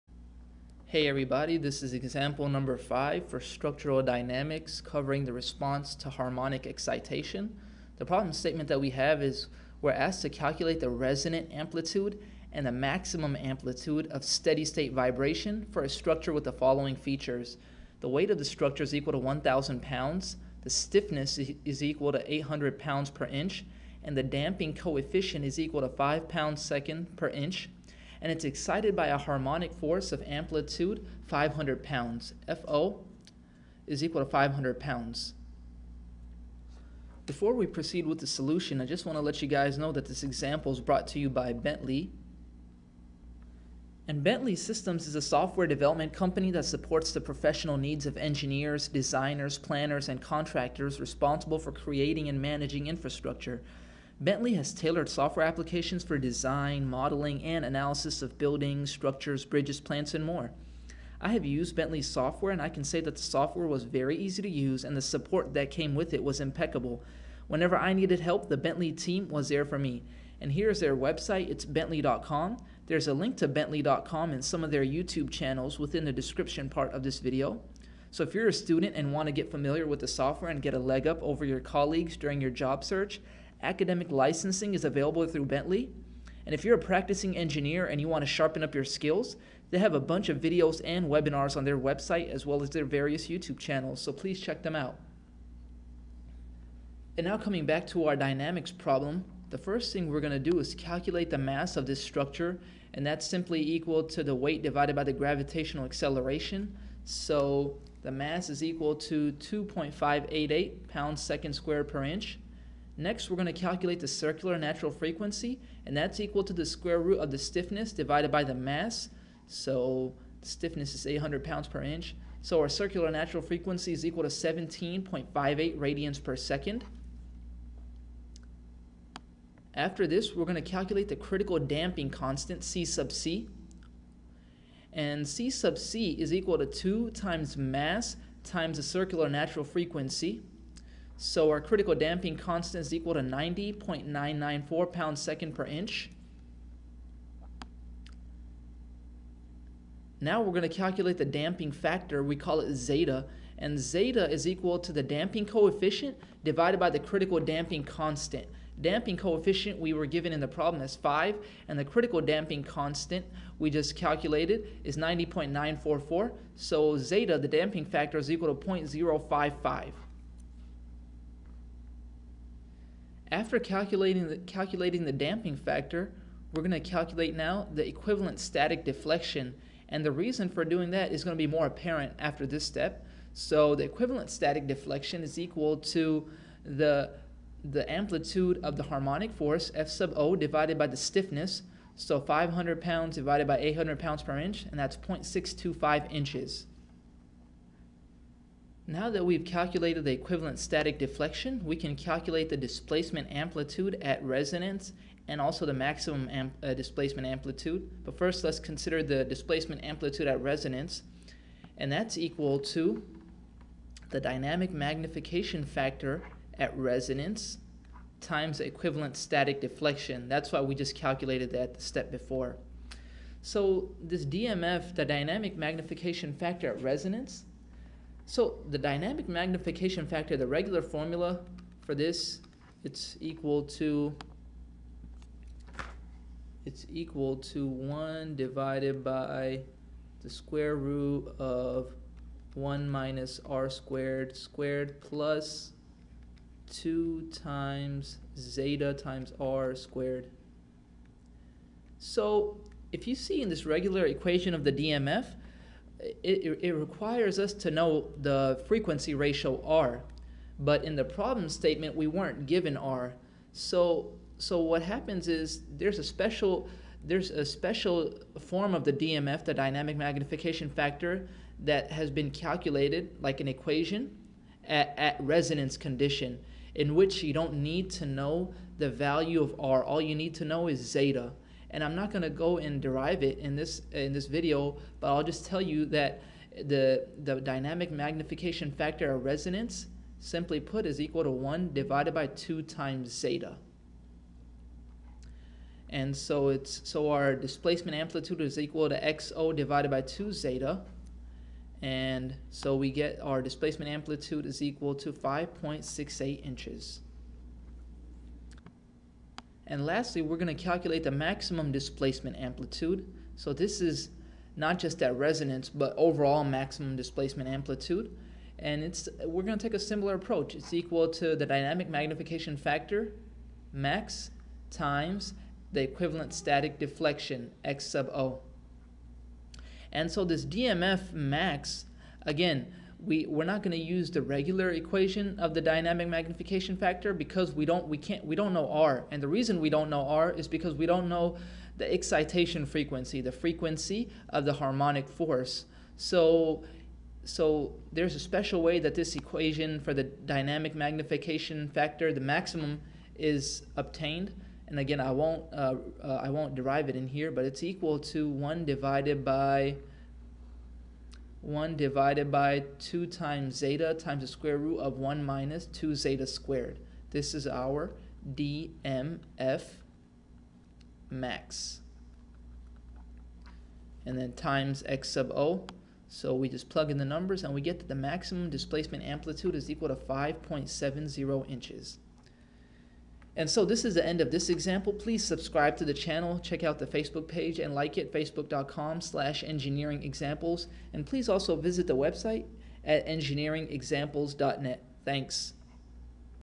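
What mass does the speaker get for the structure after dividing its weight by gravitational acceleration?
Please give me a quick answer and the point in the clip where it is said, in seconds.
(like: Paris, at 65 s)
2.588 pounds second squared per inch, at 109 s.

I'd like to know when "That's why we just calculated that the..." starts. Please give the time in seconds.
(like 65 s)
220 s.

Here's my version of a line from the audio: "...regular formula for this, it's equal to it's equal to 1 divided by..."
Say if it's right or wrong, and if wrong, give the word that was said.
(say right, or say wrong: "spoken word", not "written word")
right.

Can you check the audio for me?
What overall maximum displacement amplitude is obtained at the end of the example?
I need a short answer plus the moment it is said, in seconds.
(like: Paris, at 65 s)
5.70 inches, at 379 s.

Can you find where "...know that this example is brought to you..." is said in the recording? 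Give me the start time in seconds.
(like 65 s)
39 s.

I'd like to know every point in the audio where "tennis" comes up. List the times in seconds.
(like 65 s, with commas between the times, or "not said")
not said.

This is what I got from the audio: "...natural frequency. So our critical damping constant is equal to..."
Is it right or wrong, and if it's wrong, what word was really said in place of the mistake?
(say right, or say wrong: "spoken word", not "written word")
right.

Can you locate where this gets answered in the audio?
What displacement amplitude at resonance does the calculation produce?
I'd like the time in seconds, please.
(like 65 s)
305 s.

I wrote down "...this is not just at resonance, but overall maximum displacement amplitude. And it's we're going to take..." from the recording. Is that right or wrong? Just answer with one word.
right.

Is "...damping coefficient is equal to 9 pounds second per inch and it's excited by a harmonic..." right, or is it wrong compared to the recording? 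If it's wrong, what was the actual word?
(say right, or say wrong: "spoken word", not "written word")
wrong: "5", not "9".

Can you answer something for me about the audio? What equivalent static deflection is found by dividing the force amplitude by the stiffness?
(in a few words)
0.625 inches.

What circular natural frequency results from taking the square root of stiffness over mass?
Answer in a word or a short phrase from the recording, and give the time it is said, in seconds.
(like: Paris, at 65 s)
17.58 radians per second, at 124 s.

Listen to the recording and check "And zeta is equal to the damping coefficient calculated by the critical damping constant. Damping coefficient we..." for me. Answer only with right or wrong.
wrong.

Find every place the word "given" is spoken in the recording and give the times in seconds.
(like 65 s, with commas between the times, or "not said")
160 s, 262 s.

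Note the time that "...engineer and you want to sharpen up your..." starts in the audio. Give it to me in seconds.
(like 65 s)
87 s.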